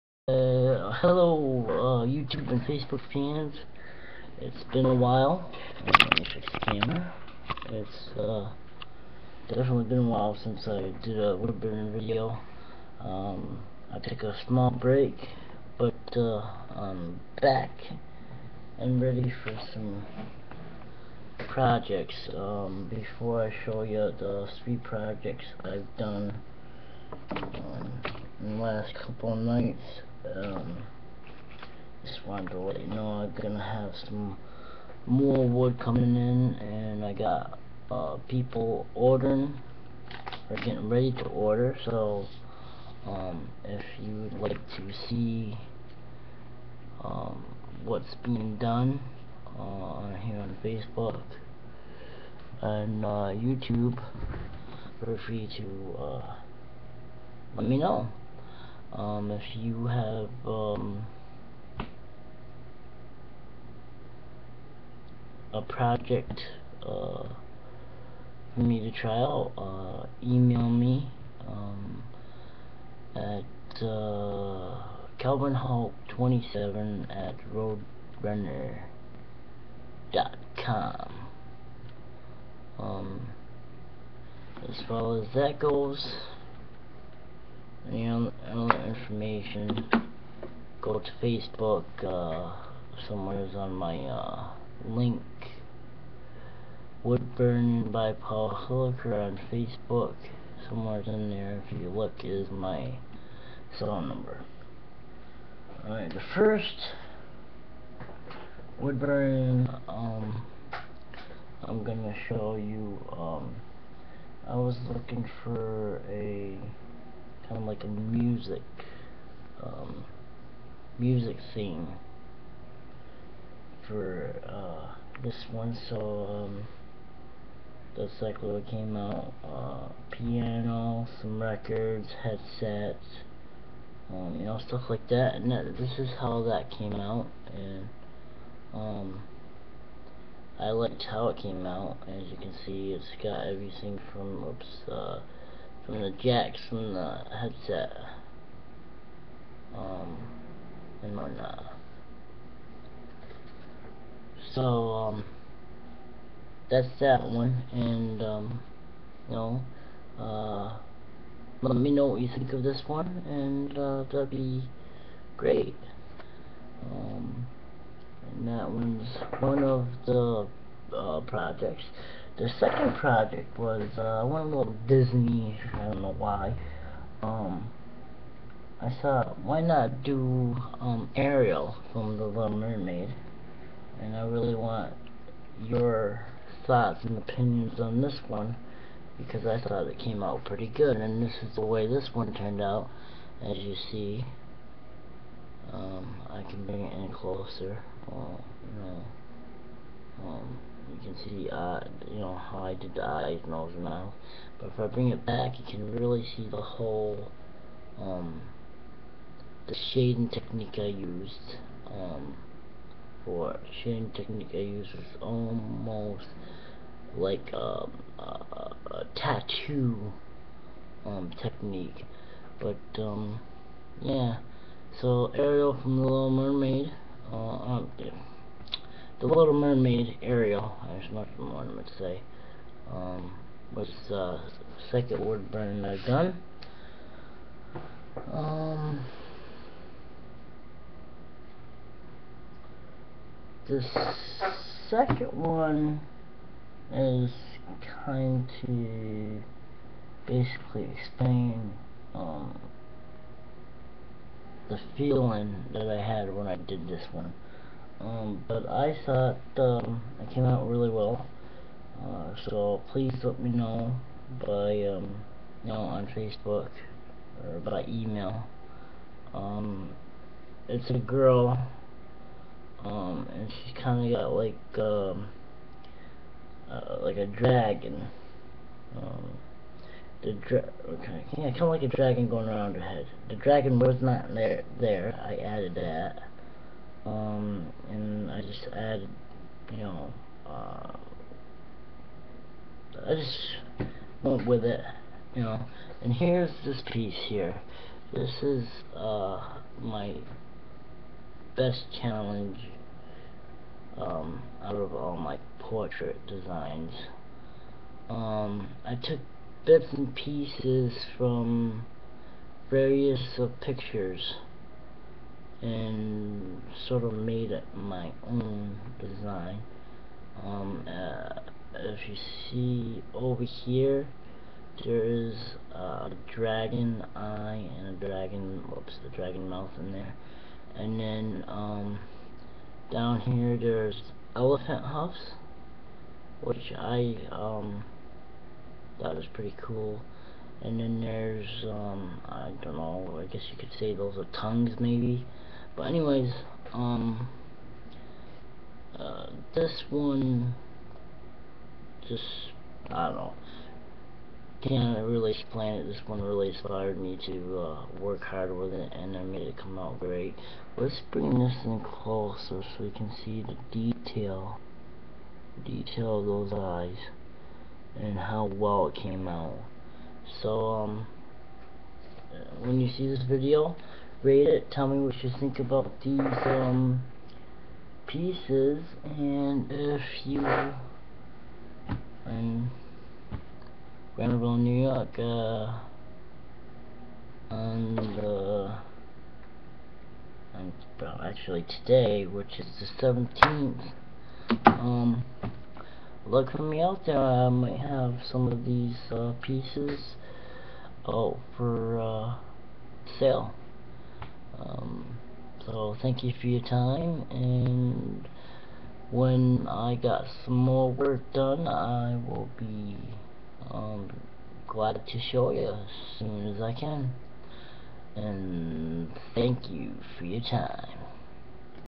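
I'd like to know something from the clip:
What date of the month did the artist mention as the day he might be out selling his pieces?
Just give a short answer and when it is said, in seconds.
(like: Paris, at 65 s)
17th, at 393 s.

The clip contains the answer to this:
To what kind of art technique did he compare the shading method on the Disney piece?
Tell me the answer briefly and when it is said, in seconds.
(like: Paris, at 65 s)
tattoo, at 219 s.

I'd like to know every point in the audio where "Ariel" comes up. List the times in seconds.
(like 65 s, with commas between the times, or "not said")
181 s, 225 s, 230 s.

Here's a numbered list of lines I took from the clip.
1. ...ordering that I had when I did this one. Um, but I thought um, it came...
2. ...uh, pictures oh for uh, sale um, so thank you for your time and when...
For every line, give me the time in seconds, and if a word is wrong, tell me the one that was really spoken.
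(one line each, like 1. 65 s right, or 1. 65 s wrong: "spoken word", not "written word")
1. 254 s wrong: "feeling", not "ordering"
2. 399 s wrong: "pieces", not "pictures".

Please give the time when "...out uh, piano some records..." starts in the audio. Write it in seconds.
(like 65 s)
128 s.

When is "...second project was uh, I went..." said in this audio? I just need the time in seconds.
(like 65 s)
172 s.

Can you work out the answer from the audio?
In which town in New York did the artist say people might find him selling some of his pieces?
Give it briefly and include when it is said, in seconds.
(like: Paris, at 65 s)
Granville, at 384 s.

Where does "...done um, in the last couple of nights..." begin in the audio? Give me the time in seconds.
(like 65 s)
25 s.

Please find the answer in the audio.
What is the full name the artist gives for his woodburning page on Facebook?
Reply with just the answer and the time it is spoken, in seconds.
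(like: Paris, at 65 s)
Woodburn by Paul Hilliker, at 97 s.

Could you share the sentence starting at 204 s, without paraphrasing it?
But if I bring it back, you can really see the whole um, the shading technique I used.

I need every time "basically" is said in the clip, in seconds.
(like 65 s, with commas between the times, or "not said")
250 s.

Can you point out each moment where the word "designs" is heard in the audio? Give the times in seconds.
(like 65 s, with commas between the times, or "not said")
306 s, 318 s.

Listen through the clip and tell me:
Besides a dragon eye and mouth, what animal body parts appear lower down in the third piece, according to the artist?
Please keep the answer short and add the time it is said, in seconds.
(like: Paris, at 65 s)
elephant huffs, at 334 s.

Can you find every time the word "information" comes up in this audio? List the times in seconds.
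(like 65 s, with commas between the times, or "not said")
88 s.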